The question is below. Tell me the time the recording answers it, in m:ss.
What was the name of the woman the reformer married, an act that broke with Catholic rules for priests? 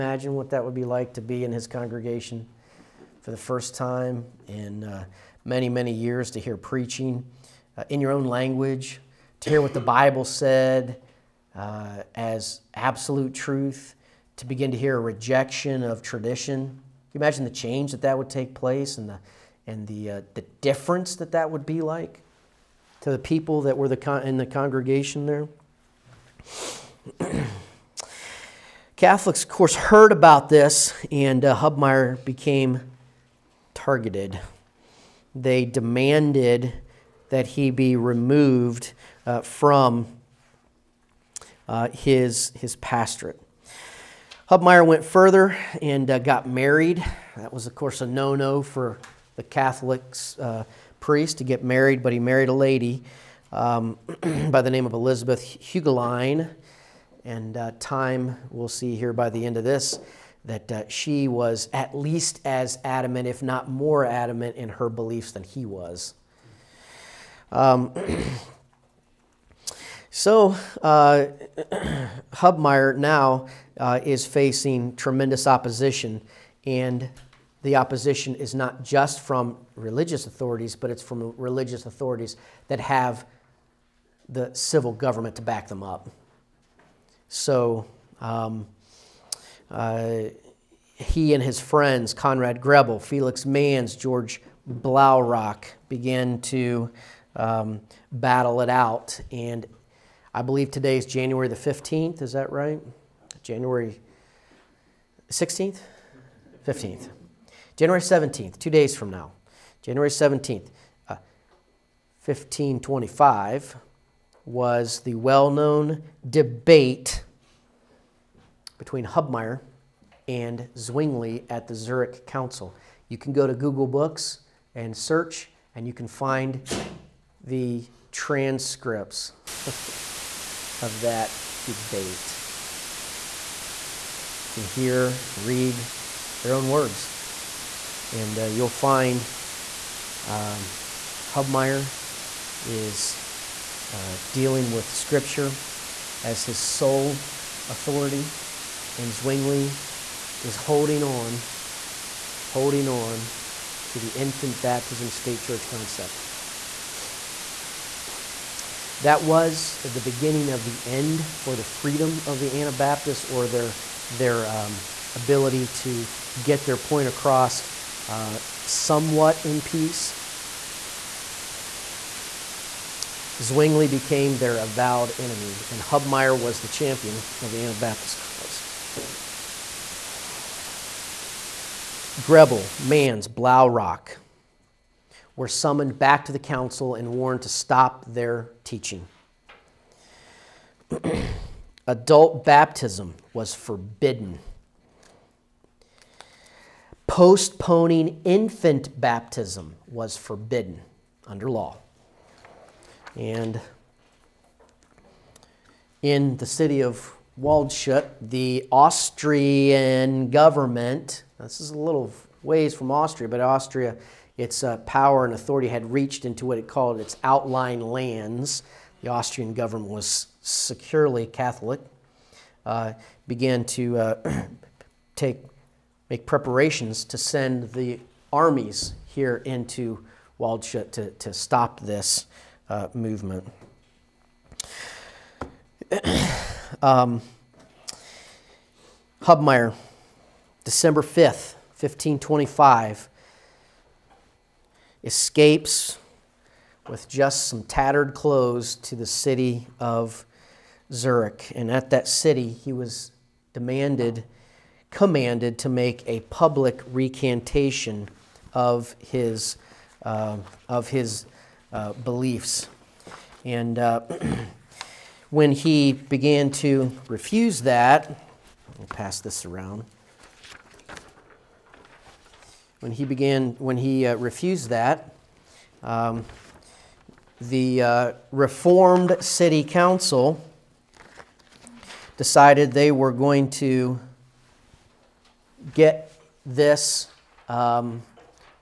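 0:54.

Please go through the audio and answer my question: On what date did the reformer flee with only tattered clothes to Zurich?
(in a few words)
December 5th, 1525.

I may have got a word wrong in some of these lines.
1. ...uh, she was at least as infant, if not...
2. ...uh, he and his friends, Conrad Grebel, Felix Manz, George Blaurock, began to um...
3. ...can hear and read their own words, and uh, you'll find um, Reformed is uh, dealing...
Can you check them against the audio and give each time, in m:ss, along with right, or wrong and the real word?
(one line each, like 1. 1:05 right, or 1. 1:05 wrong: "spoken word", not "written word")
1. 1:00 wrong: "adamant", not "infant"
2. 1:29 right
3. 2:14 wrong: "Hubmaier", not "Reformed".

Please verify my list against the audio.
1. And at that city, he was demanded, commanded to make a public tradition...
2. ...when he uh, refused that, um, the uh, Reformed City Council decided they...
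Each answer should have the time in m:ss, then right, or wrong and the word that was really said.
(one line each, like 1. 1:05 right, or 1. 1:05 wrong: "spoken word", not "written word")
1. 4:11 wrong: "recantation", not "tradition"
2. 4:33 right.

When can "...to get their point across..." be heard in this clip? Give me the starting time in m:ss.
2:45.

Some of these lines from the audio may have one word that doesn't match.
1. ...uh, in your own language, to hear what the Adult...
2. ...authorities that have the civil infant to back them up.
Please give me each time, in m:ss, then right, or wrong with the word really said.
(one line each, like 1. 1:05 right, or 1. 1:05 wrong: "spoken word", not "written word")
1. 0:07 wrong: "Bible", not "Adult"
2. 1:21 wrong: "government", not "infant".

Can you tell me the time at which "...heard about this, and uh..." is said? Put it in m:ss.
0:29.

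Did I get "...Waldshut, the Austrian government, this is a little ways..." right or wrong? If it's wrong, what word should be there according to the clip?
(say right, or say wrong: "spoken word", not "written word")
right.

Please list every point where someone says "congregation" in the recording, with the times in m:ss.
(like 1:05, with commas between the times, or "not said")
0:01, 0:24.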